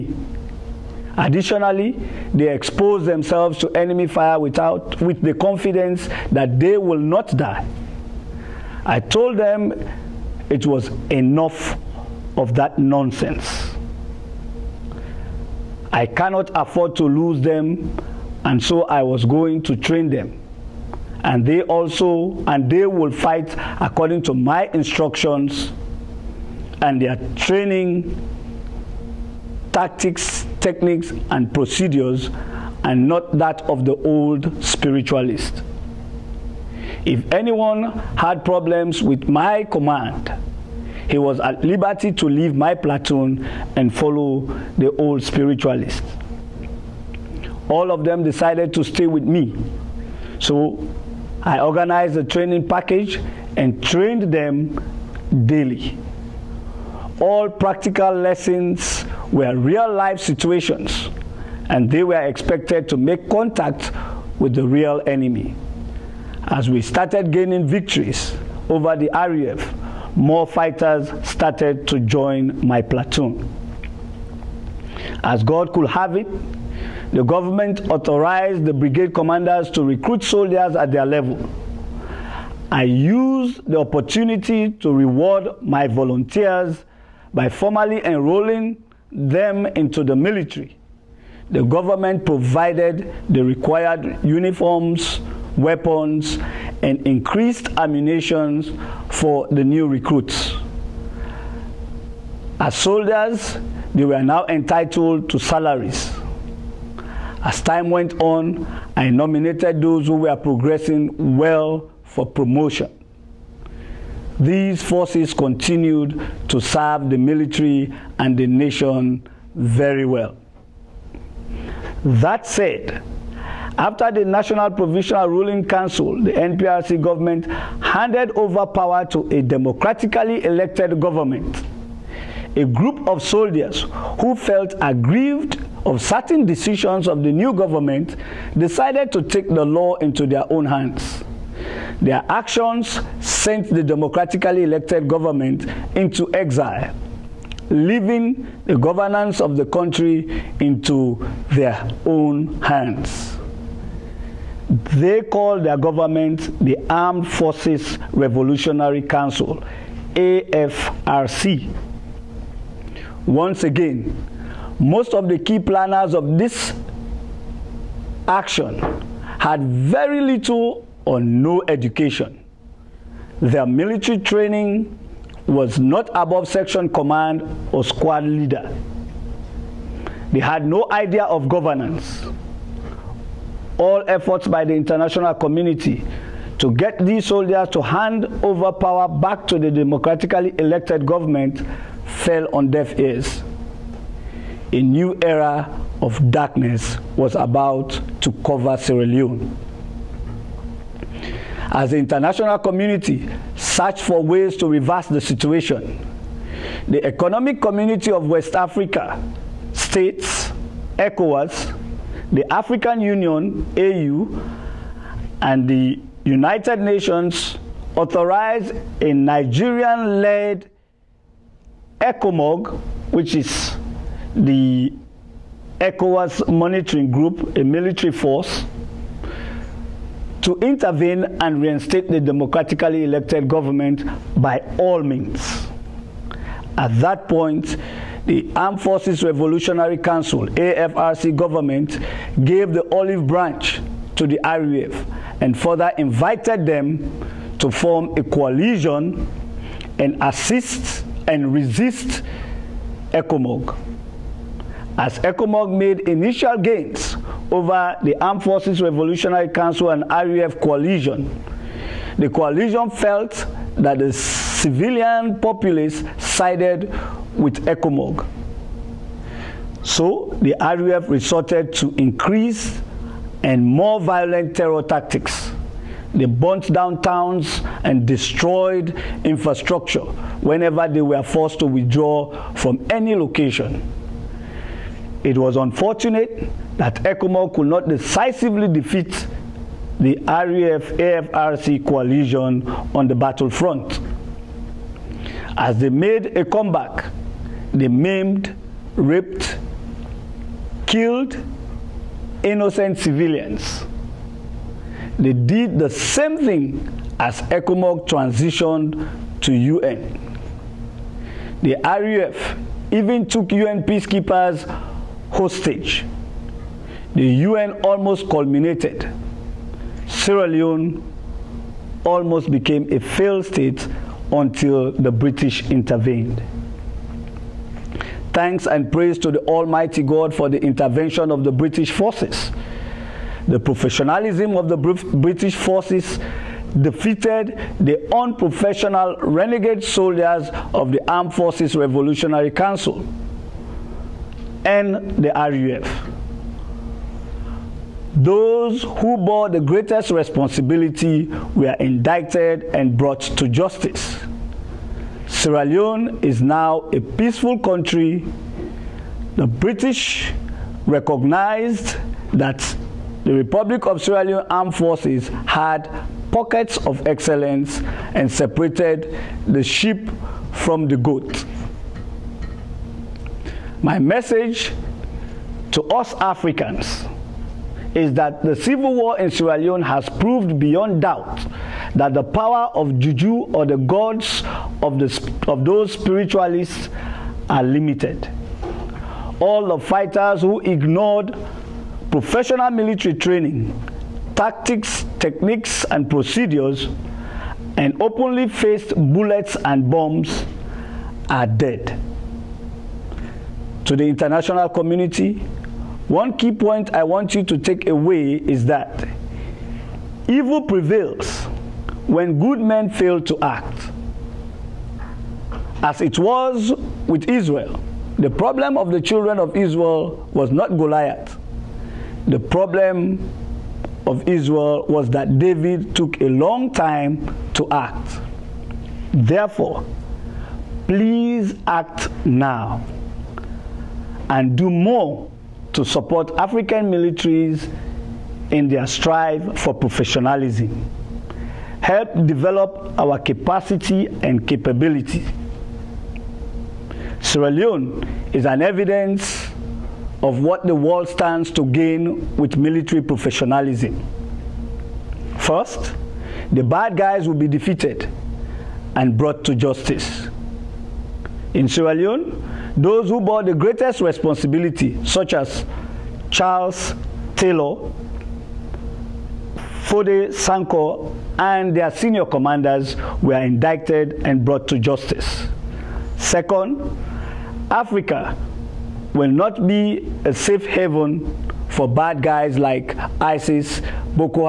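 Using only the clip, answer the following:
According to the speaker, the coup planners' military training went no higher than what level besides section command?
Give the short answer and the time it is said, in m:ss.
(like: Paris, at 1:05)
Squad leader, at 2:57.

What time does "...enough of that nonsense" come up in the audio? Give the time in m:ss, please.
0:11.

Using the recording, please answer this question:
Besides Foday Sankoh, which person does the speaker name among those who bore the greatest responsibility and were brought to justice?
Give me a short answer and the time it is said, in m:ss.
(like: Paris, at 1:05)
Charles Taylor, at 7:46.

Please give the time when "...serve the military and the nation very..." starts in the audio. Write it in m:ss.
1:56.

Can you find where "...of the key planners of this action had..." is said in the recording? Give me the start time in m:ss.
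2:45.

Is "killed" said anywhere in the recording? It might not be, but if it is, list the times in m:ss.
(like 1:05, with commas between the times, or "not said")
5:00.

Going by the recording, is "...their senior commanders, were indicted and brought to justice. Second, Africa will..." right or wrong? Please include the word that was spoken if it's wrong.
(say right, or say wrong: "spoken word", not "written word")
right.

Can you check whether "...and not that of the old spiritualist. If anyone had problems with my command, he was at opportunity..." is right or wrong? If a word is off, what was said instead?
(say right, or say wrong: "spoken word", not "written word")
wrong: "liberty", not "opportunity".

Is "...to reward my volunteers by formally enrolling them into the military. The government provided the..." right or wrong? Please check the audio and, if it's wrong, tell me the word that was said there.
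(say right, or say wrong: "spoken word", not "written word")
right.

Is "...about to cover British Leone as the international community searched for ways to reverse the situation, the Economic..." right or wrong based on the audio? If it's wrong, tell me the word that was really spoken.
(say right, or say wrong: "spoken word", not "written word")
wrong: "Sierra", not "British".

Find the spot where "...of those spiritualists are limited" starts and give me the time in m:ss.
6:25.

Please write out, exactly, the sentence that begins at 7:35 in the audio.
First, the bad guys will be defeated and brought to justice.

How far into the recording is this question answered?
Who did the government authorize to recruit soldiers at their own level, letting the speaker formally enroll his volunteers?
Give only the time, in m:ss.
1:18.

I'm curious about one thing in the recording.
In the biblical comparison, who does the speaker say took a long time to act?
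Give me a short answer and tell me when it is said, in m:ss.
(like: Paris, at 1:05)
David, at 7:05.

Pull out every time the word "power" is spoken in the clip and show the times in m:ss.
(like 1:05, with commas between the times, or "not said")
2:08, 3:08, 6:22.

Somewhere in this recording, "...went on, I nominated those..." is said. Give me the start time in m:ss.
1:47.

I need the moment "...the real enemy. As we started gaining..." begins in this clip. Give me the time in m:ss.
1:04.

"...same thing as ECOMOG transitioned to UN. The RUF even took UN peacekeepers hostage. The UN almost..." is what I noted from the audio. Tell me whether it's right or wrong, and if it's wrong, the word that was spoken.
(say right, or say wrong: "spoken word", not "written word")
right.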